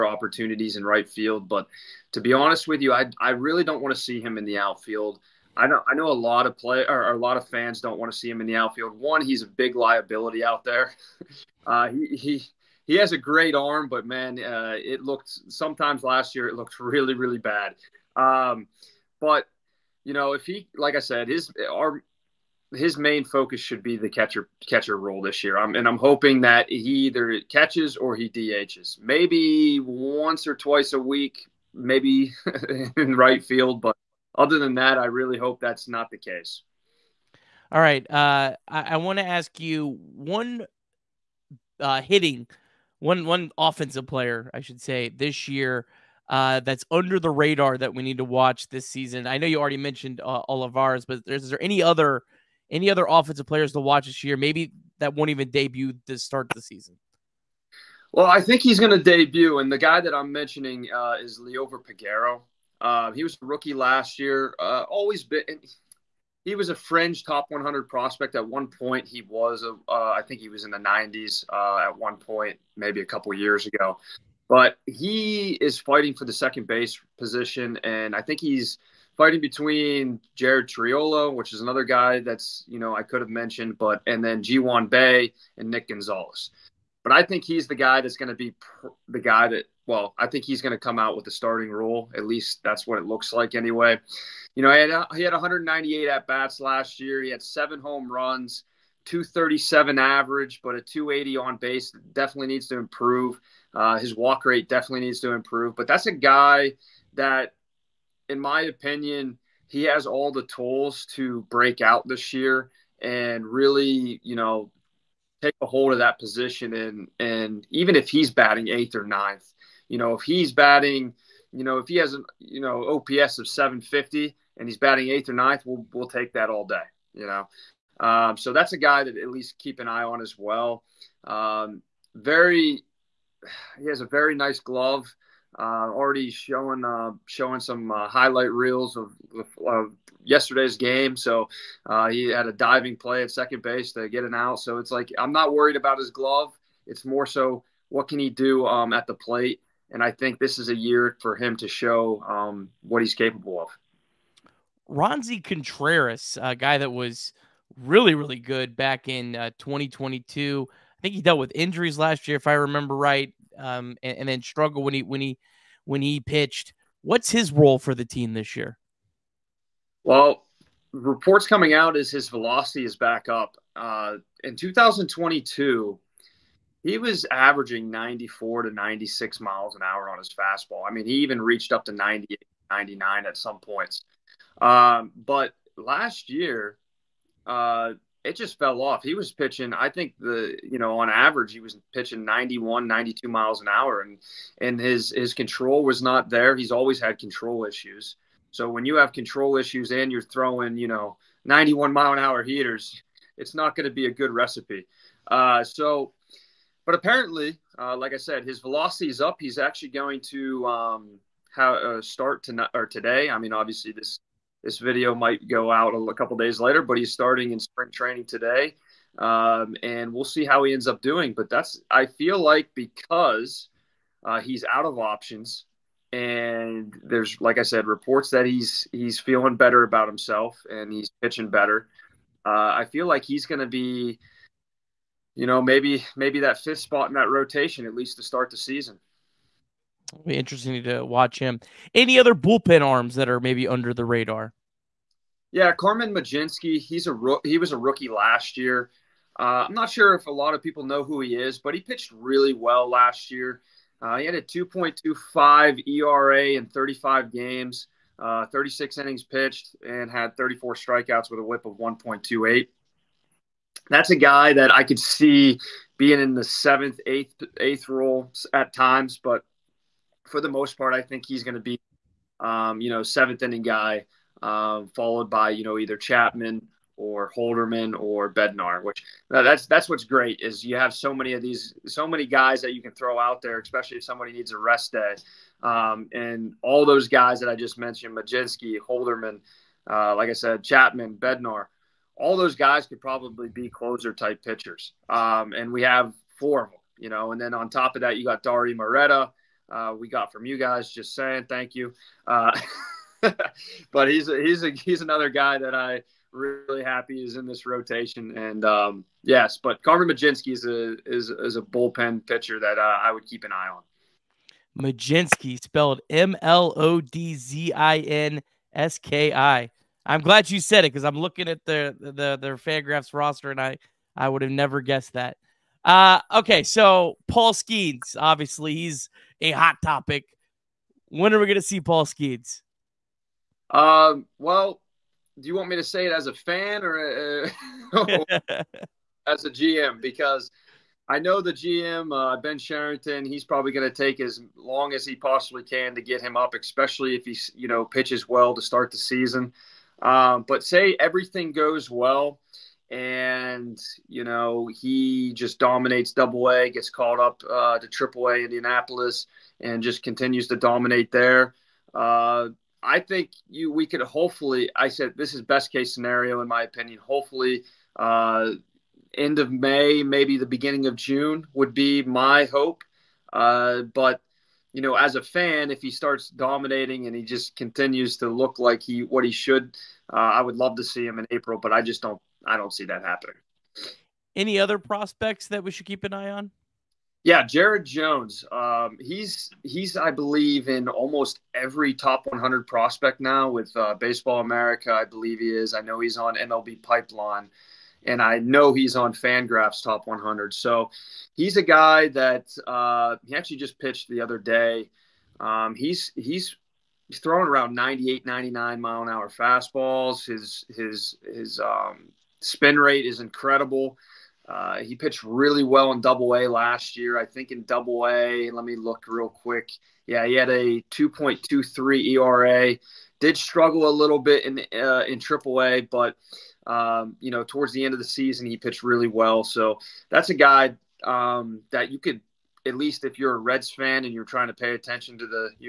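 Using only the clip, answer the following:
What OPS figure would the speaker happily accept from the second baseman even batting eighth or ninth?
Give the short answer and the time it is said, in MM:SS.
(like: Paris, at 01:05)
750, at 02:03.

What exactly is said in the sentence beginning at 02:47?
What's his role for the team this year?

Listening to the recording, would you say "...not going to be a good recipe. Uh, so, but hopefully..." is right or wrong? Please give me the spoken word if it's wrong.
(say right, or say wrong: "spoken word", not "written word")
wrong: "apparently", not "hopefully".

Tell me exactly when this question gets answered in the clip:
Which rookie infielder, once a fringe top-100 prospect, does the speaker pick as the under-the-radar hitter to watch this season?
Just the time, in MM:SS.
01:01.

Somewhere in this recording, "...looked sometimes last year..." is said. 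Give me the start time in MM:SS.
00:15.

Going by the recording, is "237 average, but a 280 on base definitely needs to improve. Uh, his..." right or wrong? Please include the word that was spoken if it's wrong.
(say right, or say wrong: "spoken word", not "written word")
right.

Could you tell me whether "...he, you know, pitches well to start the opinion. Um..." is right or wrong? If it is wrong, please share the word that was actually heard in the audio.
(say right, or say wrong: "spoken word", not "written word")
wrong: "season", not "opinion".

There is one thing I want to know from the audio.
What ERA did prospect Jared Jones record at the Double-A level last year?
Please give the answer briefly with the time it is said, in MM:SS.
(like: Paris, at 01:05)
2.23, at 07:00.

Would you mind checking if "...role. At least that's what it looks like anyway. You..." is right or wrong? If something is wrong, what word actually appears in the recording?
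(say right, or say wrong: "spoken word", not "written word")
right.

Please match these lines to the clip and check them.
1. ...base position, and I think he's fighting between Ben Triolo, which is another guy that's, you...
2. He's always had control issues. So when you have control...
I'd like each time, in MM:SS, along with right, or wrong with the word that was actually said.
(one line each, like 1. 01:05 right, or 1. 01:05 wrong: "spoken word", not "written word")
1. 01:16 wrong: "Jared", not "Ben"
2. 03:16 right.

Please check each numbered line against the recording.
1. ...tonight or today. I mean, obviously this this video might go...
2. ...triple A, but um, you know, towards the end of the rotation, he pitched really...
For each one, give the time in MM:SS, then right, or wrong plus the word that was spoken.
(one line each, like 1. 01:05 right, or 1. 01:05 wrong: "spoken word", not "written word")
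1. 03:32 right
2. 07:05 wrong: "season", not "rotation".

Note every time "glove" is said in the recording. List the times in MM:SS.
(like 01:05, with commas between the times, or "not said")
02:14, 02:26.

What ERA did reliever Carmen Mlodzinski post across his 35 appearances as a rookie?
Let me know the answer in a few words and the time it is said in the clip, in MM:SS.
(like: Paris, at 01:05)
2.25, at 04:14.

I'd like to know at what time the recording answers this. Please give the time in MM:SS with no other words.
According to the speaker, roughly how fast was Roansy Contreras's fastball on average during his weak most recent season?
03:12.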